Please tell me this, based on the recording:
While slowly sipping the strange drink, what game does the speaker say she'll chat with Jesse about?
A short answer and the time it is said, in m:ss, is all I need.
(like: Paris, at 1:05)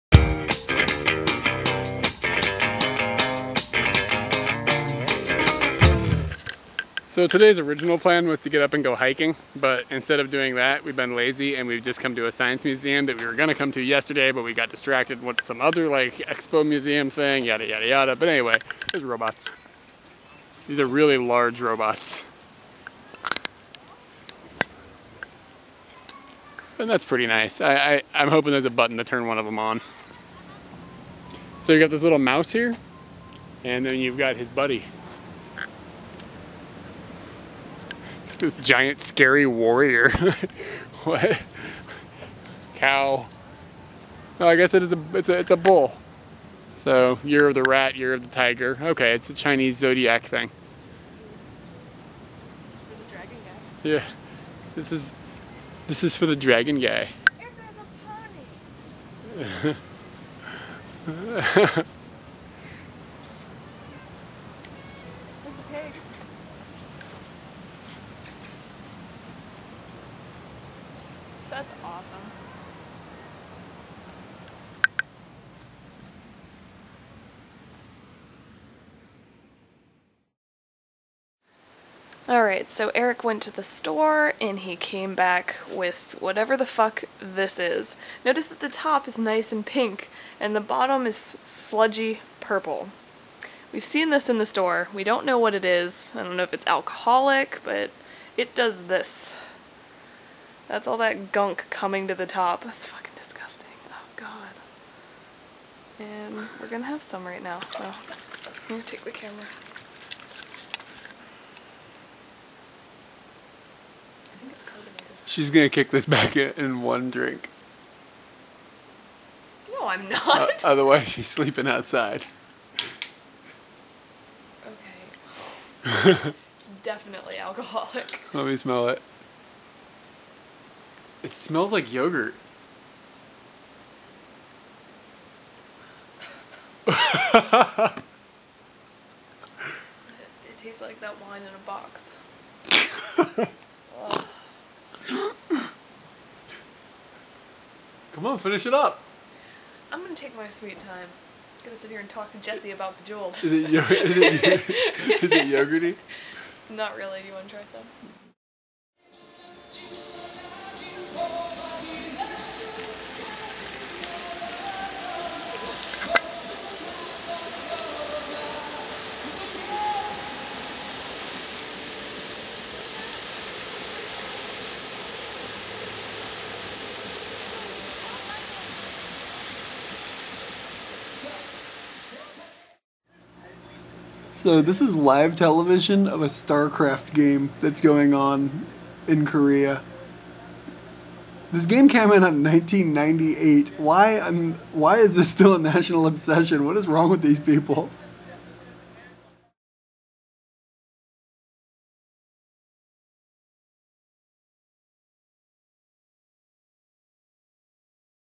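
Bejeweled, at 2:32.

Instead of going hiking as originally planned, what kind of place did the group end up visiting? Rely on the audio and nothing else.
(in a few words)
Science museum.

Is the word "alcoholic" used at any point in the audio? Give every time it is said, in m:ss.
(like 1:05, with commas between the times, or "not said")
1:36, 2:07.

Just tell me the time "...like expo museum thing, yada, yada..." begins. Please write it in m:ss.
0:15.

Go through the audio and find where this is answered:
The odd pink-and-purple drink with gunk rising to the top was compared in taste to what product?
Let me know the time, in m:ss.
2:21.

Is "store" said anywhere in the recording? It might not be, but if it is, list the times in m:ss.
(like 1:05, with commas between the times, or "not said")
1:23, 1:34.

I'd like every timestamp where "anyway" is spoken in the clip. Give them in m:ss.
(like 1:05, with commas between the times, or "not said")
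0:18.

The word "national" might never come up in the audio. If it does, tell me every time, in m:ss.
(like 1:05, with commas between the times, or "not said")
3:15.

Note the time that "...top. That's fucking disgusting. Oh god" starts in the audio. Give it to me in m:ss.
1:42.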